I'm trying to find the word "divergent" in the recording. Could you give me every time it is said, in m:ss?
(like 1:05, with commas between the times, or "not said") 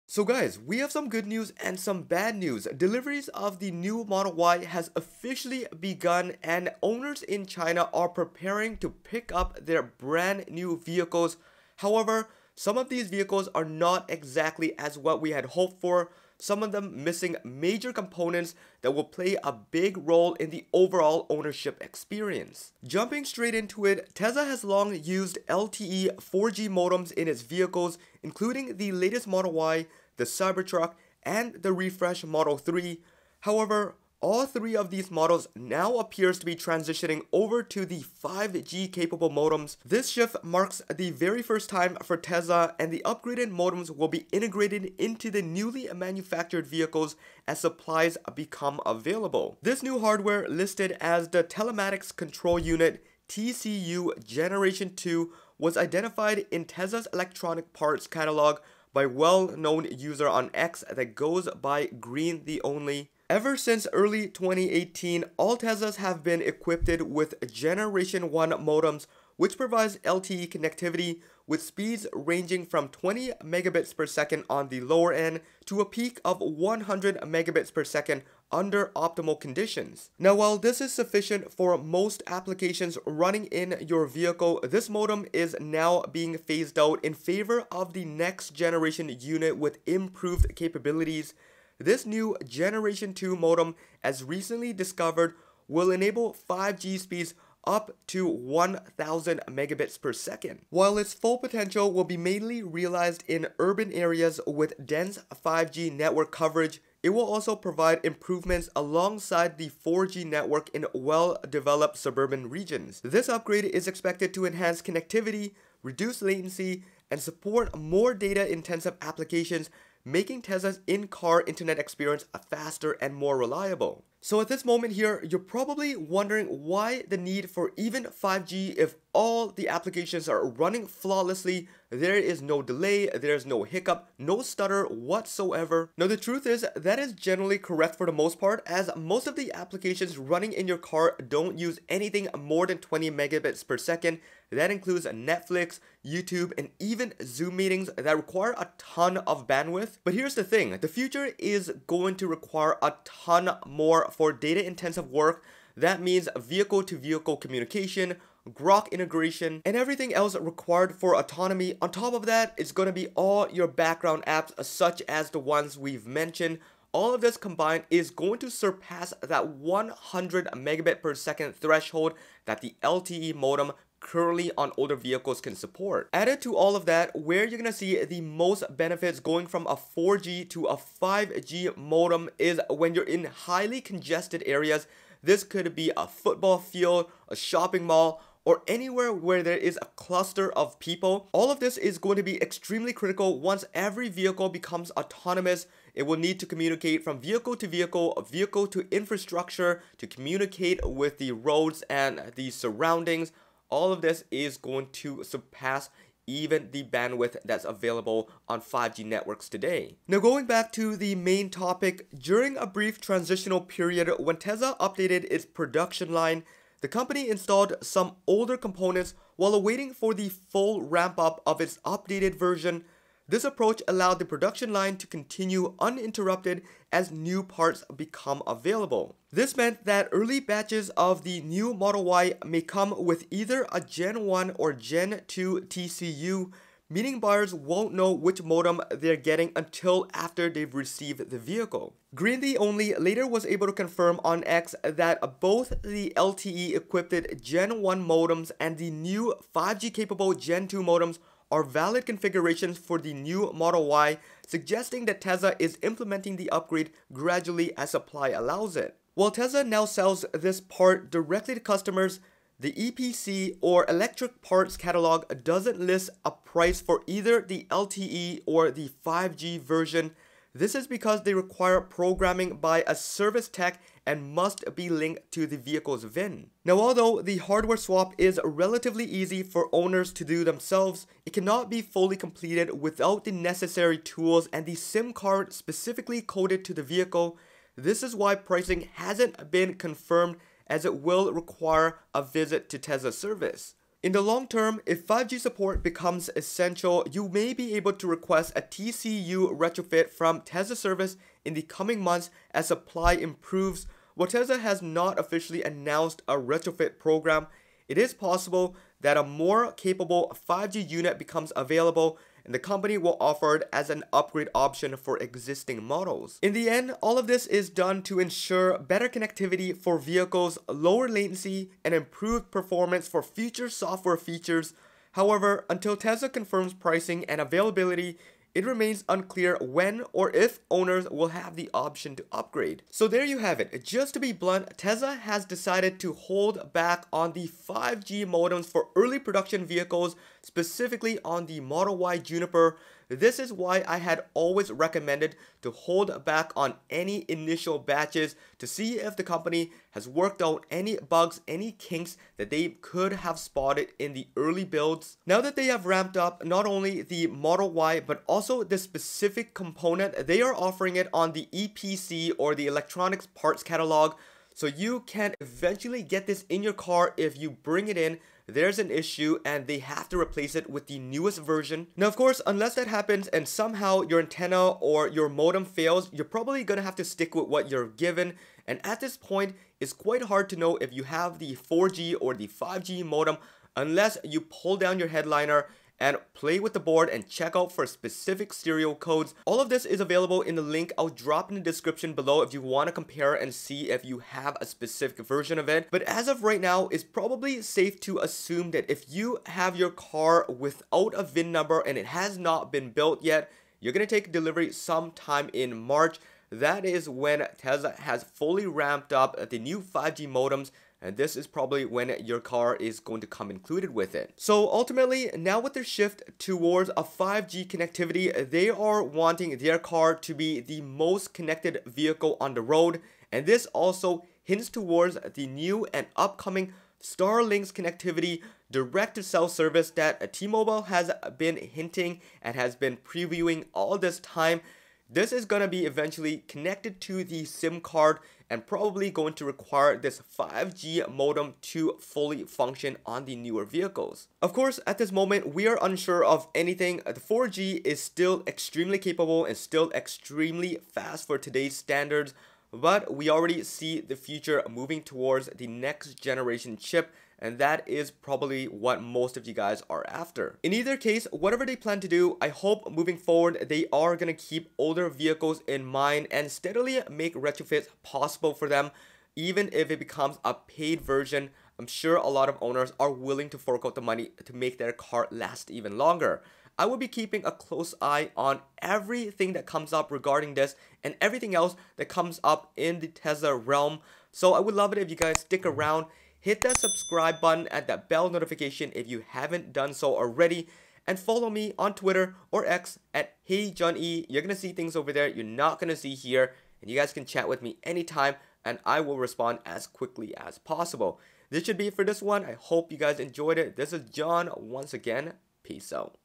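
not said.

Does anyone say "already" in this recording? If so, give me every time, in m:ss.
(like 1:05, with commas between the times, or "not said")
7:33, 8:10.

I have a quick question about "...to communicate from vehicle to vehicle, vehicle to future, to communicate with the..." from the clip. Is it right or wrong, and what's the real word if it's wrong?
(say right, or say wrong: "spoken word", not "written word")
wrong: "infrastructure", not "future".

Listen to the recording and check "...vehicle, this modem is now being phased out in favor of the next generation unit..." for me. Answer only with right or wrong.
right.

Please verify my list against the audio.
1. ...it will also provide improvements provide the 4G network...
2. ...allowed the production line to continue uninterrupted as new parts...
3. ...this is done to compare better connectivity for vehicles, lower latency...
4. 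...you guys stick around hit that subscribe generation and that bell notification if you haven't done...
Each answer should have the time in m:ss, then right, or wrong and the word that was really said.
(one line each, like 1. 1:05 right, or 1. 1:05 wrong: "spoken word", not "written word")
1. 1:47 wrong: "alongside", not "provide"
2. 3:43 right
3. 5:17 wrong: "ensure", not "compare"
4. 8:05 wrong: "button", not "generation".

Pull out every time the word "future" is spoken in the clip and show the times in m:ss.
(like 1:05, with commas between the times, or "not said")
2:30, 5:23, 7:34.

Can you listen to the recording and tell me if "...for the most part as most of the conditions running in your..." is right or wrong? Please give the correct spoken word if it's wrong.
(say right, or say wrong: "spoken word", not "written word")
wrong: "applications", not "conditions".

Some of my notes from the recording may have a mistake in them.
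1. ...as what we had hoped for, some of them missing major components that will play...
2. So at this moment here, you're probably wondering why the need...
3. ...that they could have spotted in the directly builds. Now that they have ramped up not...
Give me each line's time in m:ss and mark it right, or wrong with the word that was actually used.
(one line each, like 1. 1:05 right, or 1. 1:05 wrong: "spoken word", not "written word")
1. 0:14 right
2. 2:04 right
3. 5:52 wrong: "early", not "directly".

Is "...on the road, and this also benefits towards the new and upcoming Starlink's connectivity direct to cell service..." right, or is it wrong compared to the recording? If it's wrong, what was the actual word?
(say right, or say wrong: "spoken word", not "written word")
wrong: "hints", not "benefits".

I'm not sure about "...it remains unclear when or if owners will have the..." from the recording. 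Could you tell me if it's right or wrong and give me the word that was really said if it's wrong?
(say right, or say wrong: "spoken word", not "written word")
right.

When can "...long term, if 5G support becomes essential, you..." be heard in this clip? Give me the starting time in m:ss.
4:54.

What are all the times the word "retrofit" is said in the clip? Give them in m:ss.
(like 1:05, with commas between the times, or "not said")
4:59, 5:06, 7:47.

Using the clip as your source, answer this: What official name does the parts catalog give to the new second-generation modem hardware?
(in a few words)
Telematics Control Unit.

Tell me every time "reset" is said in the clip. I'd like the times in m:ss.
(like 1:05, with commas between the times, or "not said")
not said.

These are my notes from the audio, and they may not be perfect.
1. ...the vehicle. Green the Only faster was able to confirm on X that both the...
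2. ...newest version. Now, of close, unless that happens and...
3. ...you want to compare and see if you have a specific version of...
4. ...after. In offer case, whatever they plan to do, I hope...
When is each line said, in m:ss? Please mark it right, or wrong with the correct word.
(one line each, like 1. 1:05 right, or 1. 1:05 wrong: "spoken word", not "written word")
1. 4:01 wrong: "later", not "faster"
2. 6:10 wrong: "course", not "close"
3. 6:32 right
4. 7:40 wrong: "either", not "offer".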